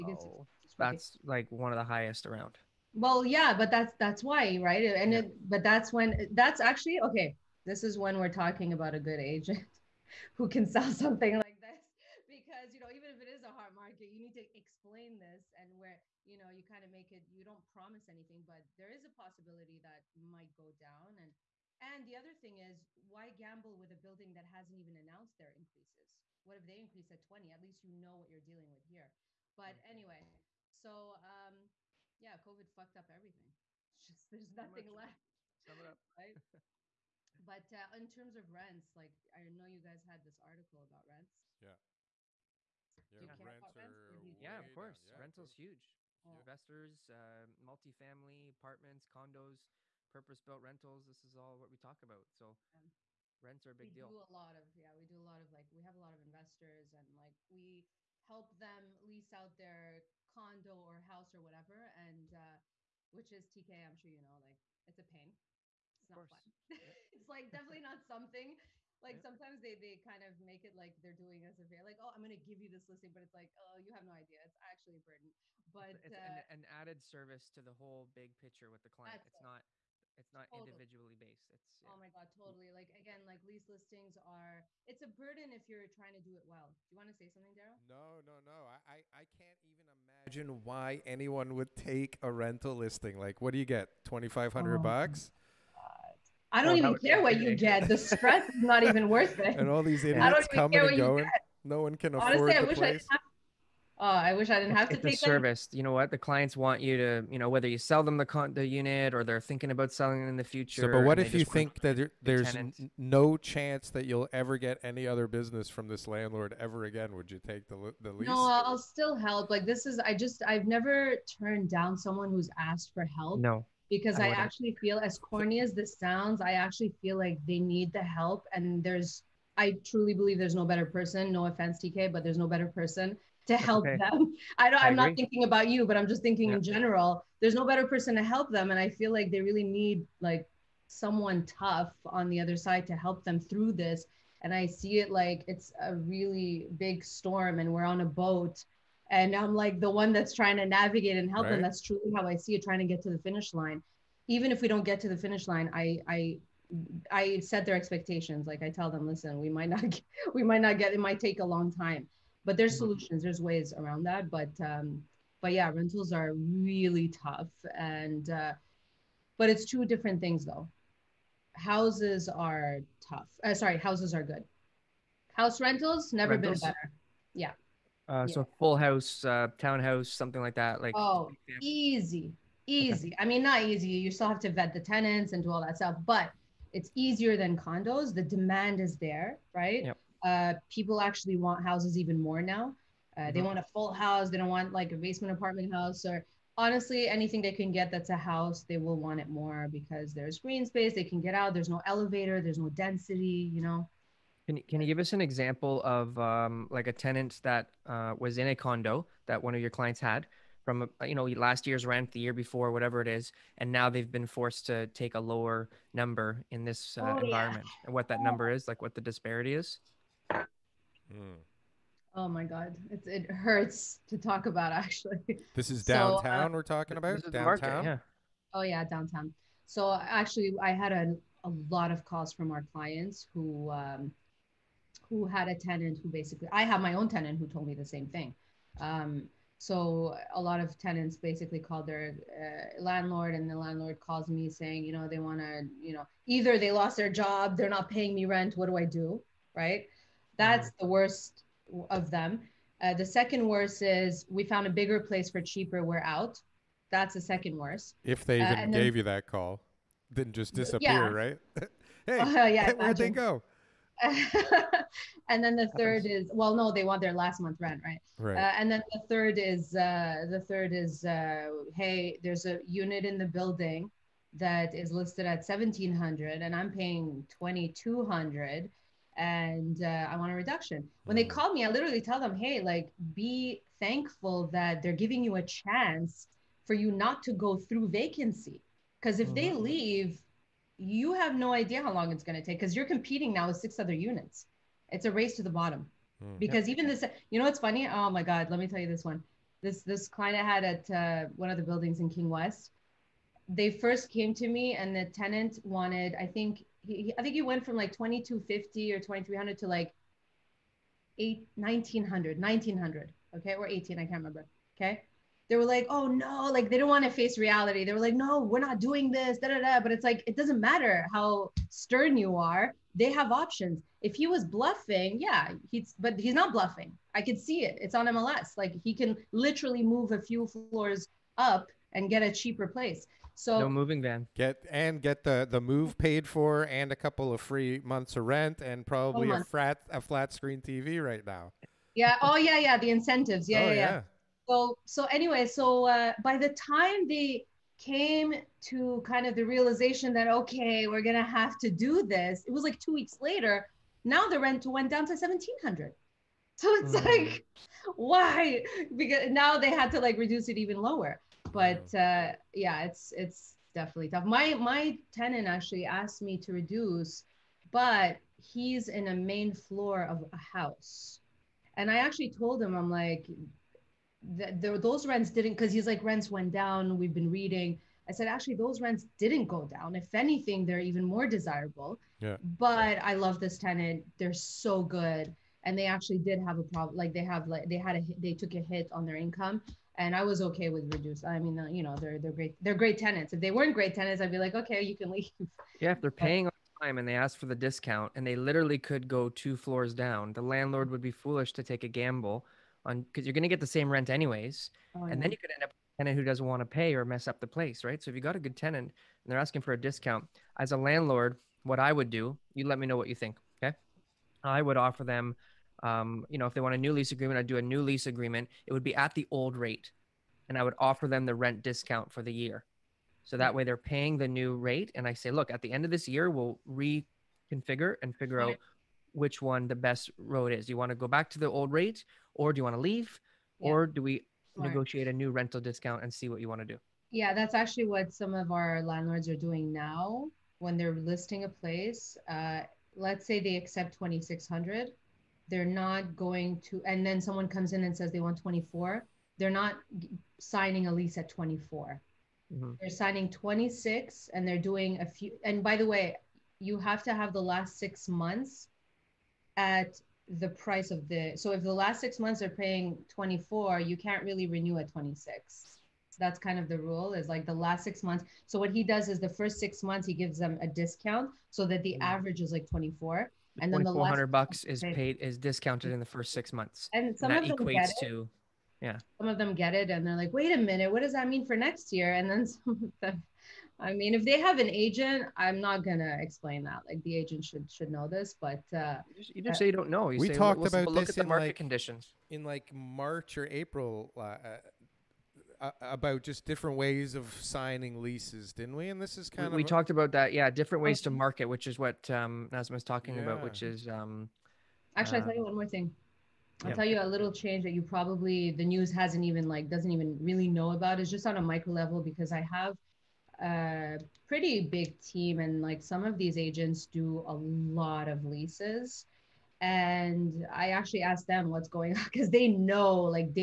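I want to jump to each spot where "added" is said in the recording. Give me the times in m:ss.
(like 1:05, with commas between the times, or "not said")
1:16.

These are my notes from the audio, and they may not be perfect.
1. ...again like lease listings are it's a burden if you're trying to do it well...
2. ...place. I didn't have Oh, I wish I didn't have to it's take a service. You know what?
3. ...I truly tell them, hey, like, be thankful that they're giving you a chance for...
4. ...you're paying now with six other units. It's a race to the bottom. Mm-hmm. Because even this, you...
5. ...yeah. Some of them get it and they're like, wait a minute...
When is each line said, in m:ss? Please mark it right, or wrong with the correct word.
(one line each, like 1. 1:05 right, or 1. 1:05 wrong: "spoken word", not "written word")
1. 1:22 right
2. 1:42 right
3. 4:41 wrong: "literally", not "truly"
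4. 4:52 wrong: "competing", not "paying"
5. 7:58 right.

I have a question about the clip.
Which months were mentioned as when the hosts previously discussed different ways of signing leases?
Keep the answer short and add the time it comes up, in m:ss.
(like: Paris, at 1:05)
March or April, at 8:12.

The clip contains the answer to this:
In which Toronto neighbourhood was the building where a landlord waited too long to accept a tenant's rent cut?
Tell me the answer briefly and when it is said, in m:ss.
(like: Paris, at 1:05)
King West, at 5:02.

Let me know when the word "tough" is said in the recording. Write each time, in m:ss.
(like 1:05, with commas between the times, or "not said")
2:21, 2:47, 2:53, 6:04.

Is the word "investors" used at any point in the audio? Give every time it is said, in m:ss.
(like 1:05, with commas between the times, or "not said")
0:46, 0:56.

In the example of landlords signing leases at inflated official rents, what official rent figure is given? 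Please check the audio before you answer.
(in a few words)
2600.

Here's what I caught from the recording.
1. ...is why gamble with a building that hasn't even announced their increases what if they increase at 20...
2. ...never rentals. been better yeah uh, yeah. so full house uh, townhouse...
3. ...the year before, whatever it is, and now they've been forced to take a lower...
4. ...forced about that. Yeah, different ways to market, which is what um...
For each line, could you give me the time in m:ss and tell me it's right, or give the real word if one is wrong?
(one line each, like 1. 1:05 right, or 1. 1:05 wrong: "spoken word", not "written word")
1. 0:22 right
2. 2:56 right
3. 3:32 right
4. 8:19 wrong: "talked", not "forced".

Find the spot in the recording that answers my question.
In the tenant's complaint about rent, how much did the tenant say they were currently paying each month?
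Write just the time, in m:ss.
4:37.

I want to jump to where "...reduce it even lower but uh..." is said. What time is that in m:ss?
6:00.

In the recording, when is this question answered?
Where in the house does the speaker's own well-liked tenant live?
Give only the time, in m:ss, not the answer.
6:09.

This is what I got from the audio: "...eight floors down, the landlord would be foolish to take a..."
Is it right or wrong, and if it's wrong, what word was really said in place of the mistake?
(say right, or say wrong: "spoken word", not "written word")
wrong: "two", not "eight".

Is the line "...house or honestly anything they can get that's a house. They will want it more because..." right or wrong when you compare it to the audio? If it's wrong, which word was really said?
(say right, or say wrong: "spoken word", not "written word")
right.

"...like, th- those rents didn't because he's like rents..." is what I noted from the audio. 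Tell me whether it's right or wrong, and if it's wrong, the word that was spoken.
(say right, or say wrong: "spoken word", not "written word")
right.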